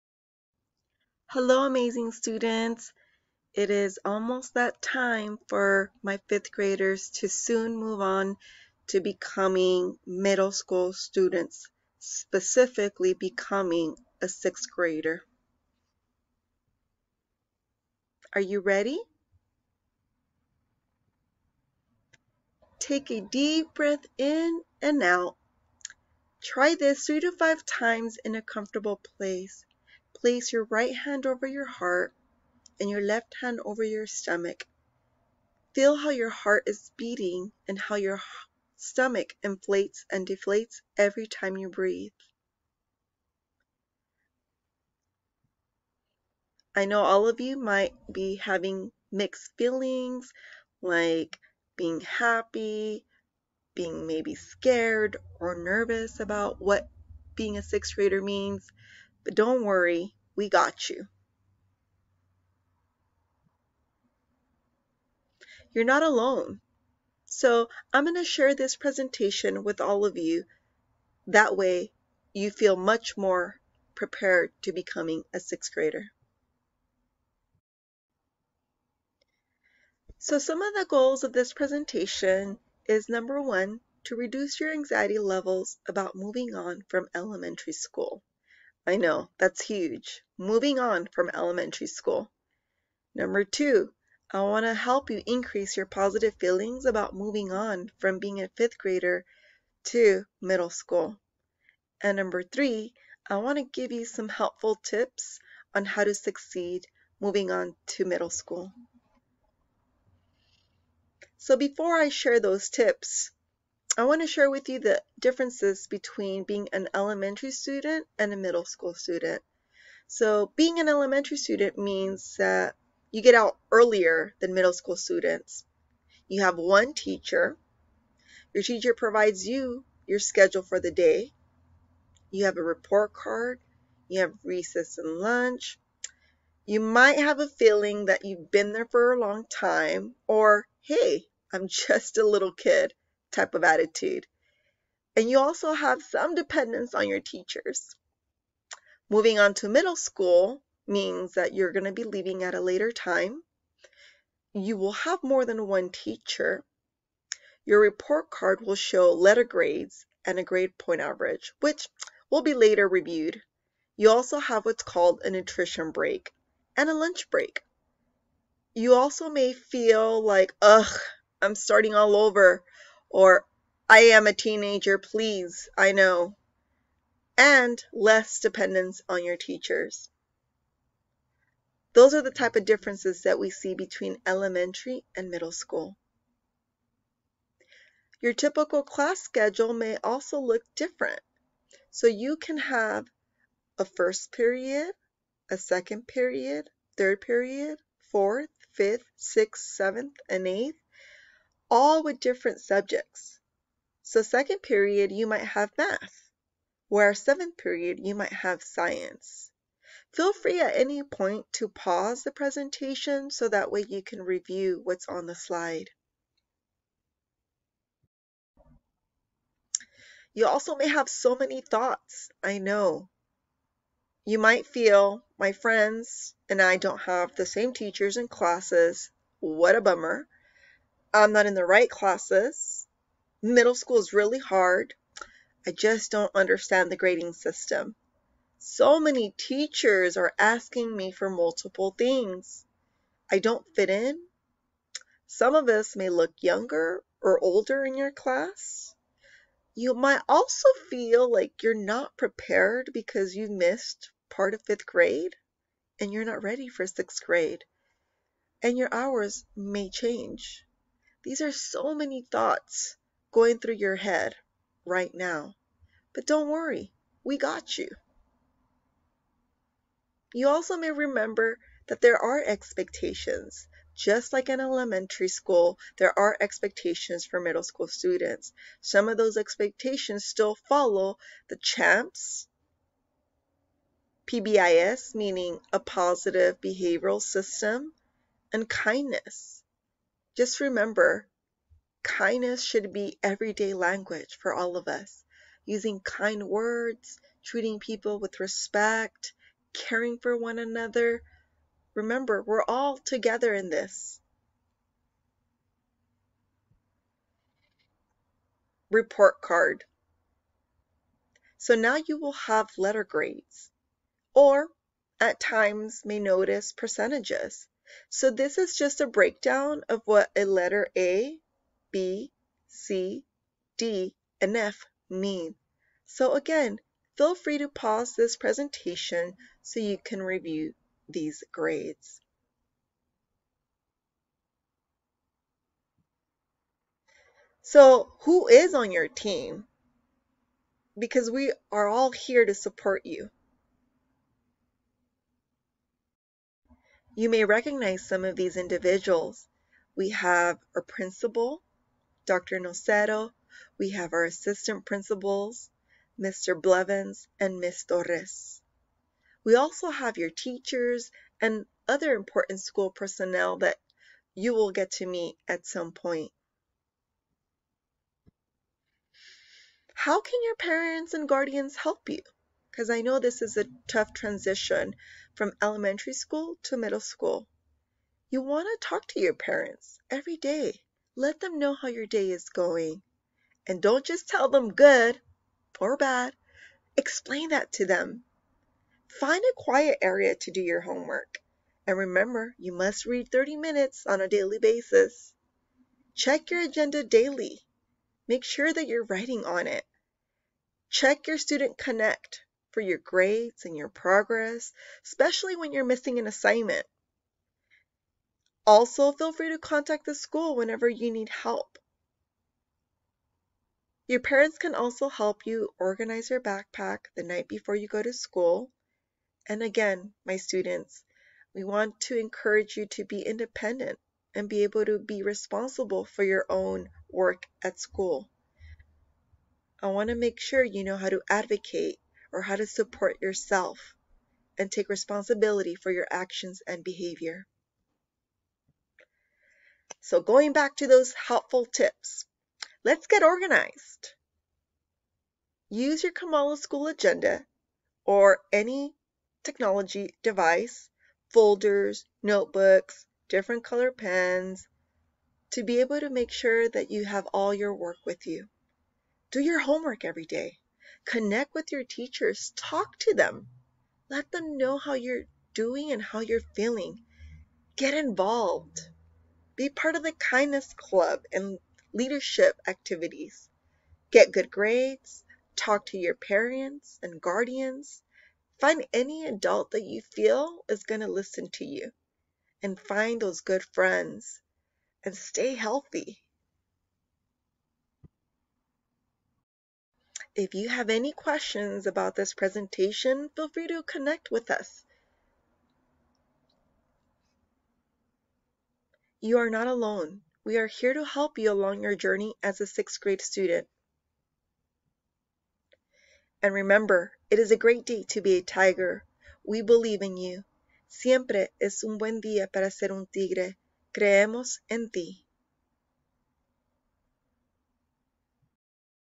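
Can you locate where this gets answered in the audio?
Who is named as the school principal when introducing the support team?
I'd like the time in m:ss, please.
5:52.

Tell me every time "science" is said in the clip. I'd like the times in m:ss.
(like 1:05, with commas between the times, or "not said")
3:28.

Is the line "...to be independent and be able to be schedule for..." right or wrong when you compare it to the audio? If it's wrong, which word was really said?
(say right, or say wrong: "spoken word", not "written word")
wrong: "responsible", not "schedule".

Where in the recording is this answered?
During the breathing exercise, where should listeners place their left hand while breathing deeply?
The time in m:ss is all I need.
0:33.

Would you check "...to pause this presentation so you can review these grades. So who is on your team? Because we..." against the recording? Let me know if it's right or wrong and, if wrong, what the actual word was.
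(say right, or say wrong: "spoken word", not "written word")
right.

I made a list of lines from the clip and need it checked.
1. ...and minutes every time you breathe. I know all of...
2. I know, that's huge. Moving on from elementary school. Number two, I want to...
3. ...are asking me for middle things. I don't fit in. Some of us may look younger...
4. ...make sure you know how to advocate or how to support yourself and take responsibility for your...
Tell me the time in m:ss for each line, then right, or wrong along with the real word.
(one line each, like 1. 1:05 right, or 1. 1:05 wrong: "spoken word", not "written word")
1. 0:40 wrong: "deflates", not "minutes"
2. 1:28 right
3. 4:00 wrong: "multiple", not "middle"
4. 7:10 right.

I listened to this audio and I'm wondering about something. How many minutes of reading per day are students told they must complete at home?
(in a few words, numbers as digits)
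30.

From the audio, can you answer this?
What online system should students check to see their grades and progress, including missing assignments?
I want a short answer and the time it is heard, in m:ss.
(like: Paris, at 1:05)
Student Connect, at 6:41.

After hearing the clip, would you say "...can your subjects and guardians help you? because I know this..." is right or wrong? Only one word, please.
wrong.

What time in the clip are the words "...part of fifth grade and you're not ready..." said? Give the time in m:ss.
4:14.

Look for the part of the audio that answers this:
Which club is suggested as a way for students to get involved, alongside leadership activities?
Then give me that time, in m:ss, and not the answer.
7:50.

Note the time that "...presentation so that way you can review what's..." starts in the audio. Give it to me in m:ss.
3:32.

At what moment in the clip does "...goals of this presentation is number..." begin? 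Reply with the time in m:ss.
1:20.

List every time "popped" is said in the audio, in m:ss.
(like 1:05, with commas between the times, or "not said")
not said.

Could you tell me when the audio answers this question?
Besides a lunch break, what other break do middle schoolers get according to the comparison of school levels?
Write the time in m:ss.
2:45.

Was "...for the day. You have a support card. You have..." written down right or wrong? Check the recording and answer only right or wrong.
wrong.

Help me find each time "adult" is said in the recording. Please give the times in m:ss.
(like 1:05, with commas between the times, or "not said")
7:59.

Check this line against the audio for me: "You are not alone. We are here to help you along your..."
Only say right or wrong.
right.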